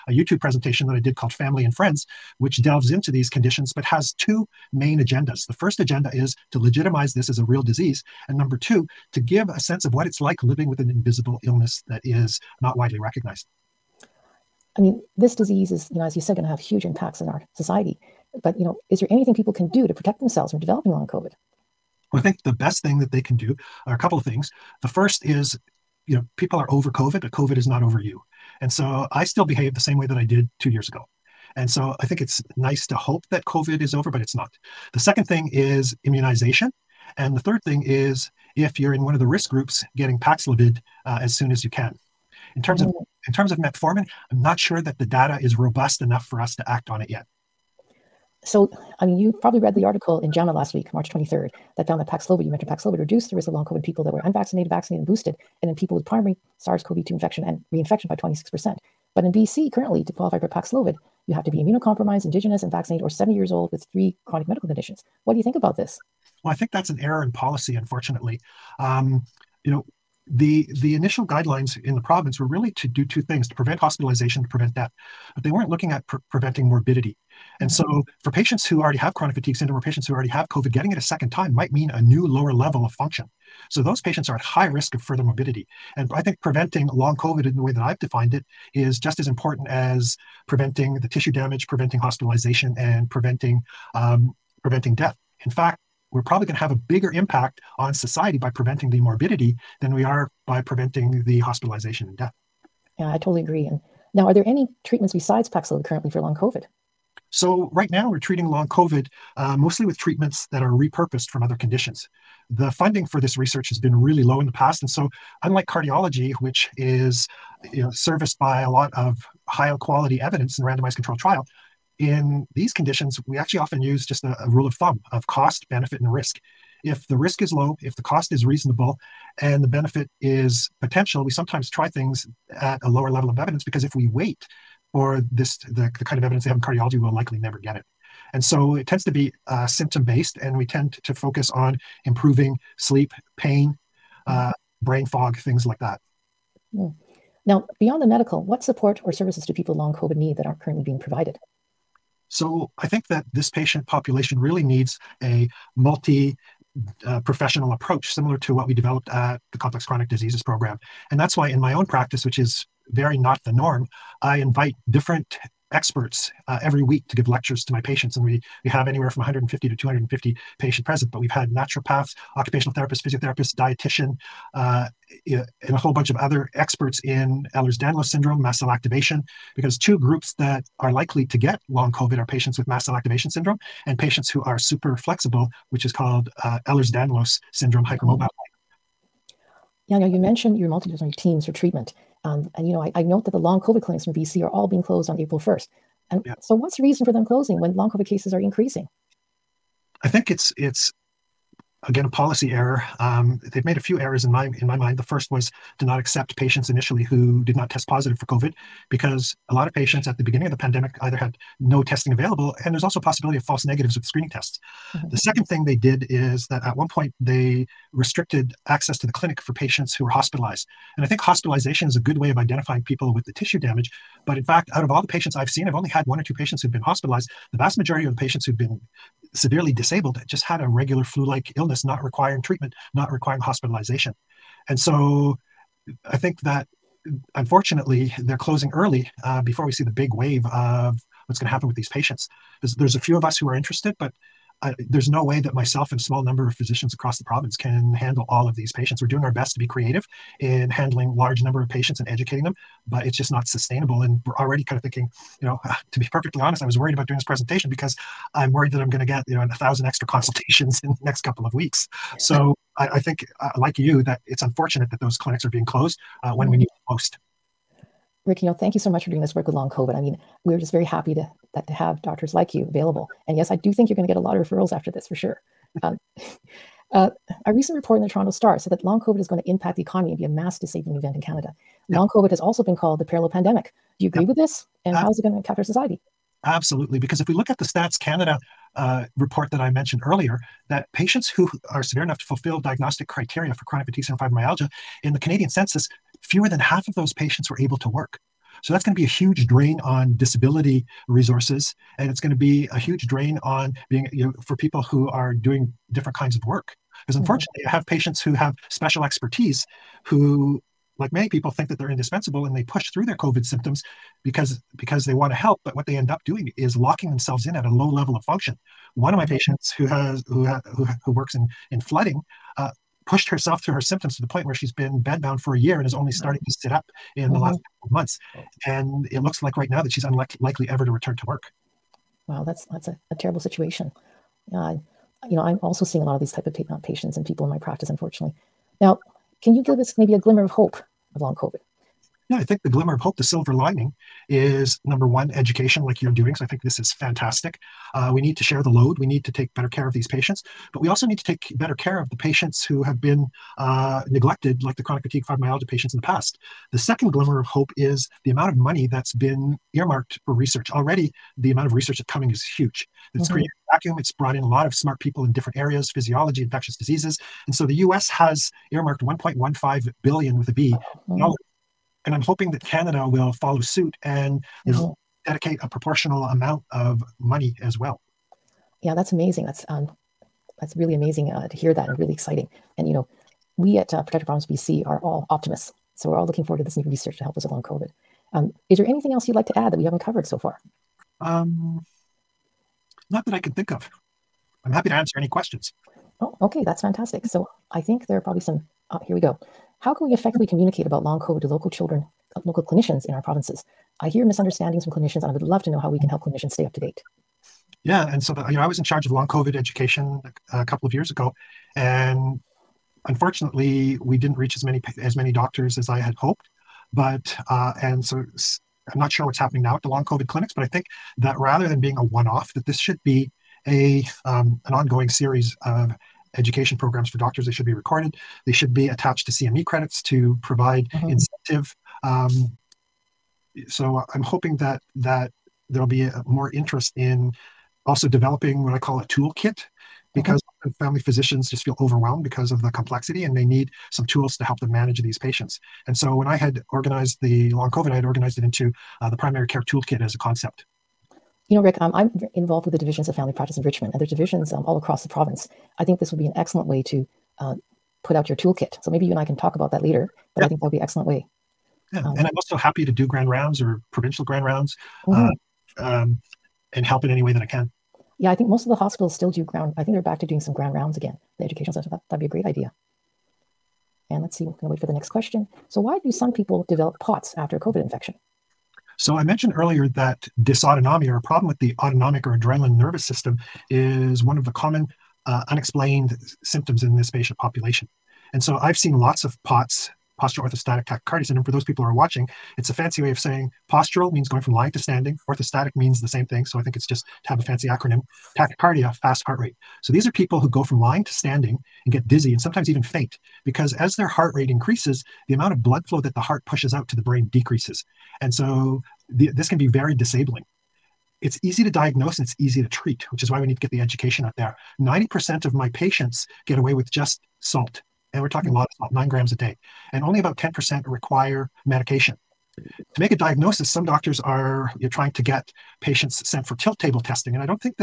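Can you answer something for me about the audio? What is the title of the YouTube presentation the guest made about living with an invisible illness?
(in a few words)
Family and Friends.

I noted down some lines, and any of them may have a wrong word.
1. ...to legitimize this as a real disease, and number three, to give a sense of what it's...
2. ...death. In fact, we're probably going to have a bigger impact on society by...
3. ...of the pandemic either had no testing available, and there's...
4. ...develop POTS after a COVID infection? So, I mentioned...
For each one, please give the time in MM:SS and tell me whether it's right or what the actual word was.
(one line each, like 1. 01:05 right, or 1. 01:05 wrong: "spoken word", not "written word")
1. 00:06 wrong: "two", not "three"
2. 01:34 right
3. 03:30 right
4. 07:56 right.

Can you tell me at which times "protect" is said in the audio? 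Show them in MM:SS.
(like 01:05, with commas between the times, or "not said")
00:19, 06:24.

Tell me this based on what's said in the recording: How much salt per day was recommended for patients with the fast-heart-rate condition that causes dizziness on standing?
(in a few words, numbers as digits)
9 grams.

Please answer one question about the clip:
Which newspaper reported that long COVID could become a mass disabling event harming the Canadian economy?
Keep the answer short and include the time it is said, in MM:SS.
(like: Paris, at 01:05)
Toronto Star, at 04:38.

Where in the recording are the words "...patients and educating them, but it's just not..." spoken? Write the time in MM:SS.
04:11.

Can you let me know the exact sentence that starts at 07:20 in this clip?
family physicians just feel overwhelmed because of the complexity and they need some tools to help them manage these patients.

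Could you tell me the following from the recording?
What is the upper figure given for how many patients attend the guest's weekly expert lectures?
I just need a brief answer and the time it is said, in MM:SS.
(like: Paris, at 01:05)
250, at 02:49.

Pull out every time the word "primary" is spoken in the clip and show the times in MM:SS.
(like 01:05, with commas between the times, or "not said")
00:56, 07:29.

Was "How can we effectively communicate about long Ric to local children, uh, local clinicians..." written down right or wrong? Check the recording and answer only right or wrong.
wrong.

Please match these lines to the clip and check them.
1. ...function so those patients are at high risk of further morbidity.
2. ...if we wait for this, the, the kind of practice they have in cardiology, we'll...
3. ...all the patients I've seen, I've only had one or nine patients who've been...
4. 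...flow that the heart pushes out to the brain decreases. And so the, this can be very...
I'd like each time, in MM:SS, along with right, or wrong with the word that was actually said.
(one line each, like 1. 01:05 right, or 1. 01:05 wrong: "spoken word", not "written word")
1. 01:22 right
2. 02:13 wrong: "evidence", not "practice"
3. 03:44 wrong: "two", not "nine"
4. 08:25 right.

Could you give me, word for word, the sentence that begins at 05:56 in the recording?
The second glimmer of hope is the amount of money that's been earmarked for research.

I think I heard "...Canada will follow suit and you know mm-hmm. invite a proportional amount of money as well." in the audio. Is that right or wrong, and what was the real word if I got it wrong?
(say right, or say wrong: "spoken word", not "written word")
wrong: "dedicate", not "invite".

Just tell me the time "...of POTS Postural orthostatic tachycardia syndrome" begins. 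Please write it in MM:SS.
08:09.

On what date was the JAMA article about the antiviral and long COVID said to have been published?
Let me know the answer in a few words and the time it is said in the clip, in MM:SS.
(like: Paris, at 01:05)
March 23rd, at 00:50.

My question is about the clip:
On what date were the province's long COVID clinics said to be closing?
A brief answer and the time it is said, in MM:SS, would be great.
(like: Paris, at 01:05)
April 1st, at 03:15.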